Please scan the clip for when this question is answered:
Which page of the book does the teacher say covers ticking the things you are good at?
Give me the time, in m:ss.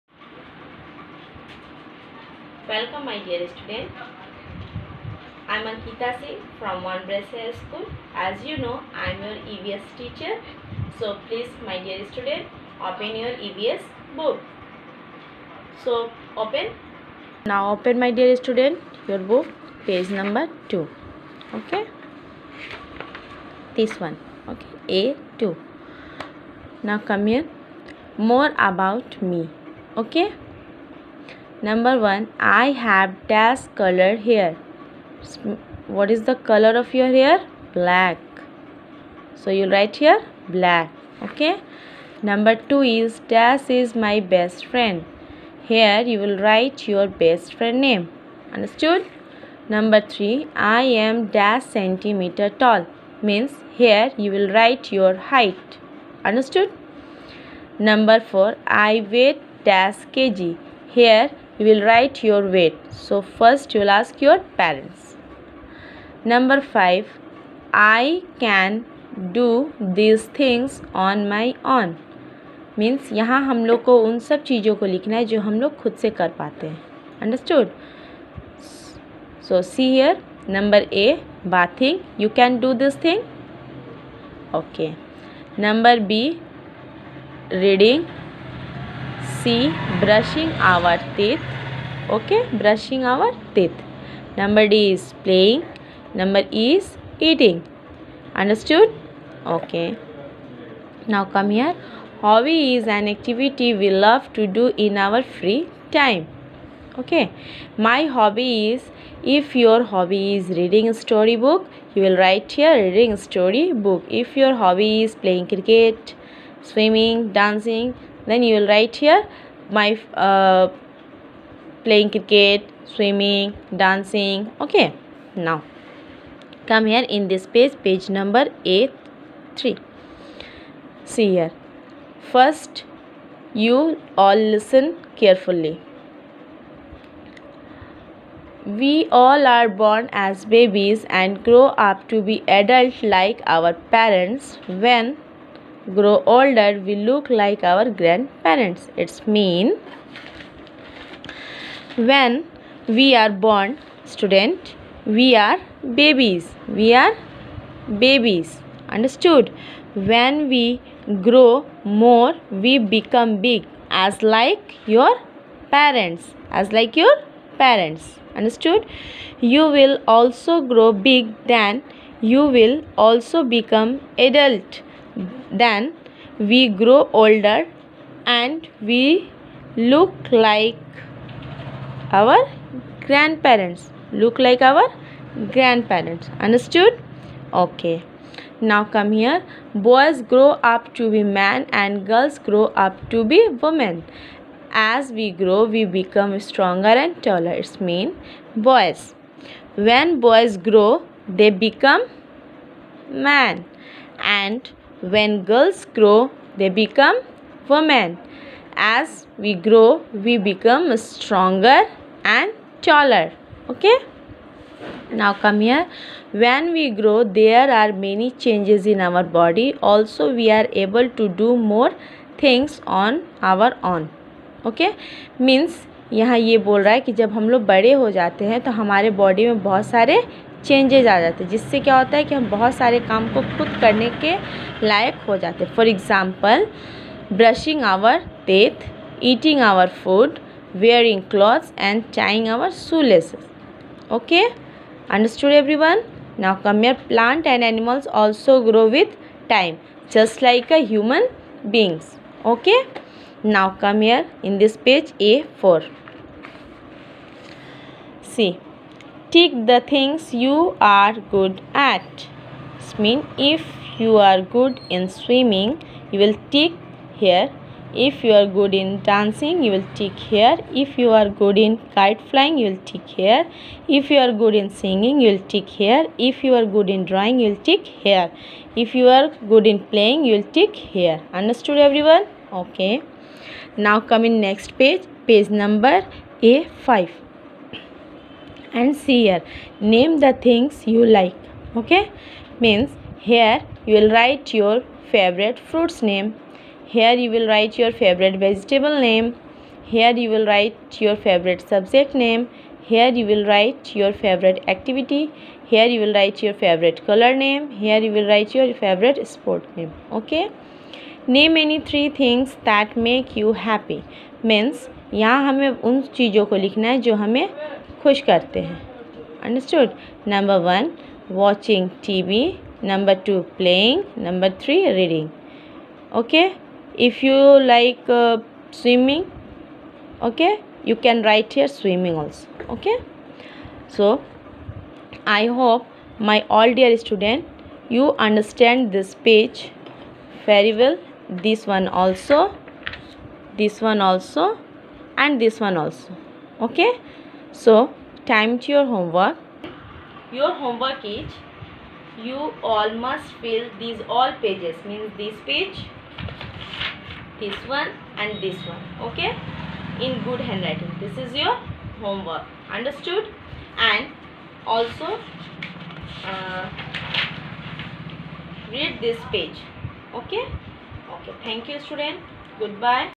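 4:15.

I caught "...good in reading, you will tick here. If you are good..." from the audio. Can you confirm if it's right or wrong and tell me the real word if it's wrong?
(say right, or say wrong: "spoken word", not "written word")
wrong: "dancing", not "reading".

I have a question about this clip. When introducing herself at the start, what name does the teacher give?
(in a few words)
Ankita Singh.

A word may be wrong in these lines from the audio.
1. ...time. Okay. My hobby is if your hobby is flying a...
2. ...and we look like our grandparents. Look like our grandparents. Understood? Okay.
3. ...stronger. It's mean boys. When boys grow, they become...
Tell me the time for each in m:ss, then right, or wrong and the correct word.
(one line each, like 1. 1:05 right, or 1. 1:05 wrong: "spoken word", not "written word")
1. 1:45 wrong: "reading", not "flying"
2. 2:58 right
3. 3:17 wrong: "taller", not "stronger".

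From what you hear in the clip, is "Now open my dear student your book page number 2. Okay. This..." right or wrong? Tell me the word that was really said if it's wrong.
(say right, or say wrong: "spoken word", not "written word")
right.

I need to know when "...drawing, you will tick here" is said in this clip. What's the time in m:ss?
4:37.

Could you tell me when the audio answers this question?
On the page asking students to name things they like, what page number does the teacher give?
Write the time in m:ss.
4:46.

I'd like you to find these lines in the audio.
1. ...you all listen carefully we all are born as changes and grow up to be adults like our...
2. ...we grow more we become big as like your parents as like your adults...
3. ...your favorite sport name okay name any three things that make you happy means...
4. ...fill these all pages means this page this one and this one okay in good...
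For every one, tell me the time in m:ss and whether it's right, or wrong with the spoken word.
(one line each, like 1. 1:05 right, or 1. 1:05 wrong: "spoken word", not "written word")
1. 2:13 wrong: "babies", not "changes"
2. 2:40 wrong: "parents", not "adults"
3. 5:08 right
4. 5:53 right.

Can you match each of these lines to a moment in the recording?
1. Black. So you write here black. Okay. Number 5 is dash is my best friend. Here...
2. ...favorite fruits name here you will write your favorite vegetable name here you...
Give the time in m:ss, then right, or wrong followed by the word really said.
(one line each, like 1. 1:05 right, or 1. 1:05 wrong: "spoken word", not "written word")
1. 0:37 wrong: "2", not "5"
2. 4:55 right.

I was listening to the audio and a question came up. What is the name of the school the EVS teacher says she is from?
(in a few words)
Montbretia High School.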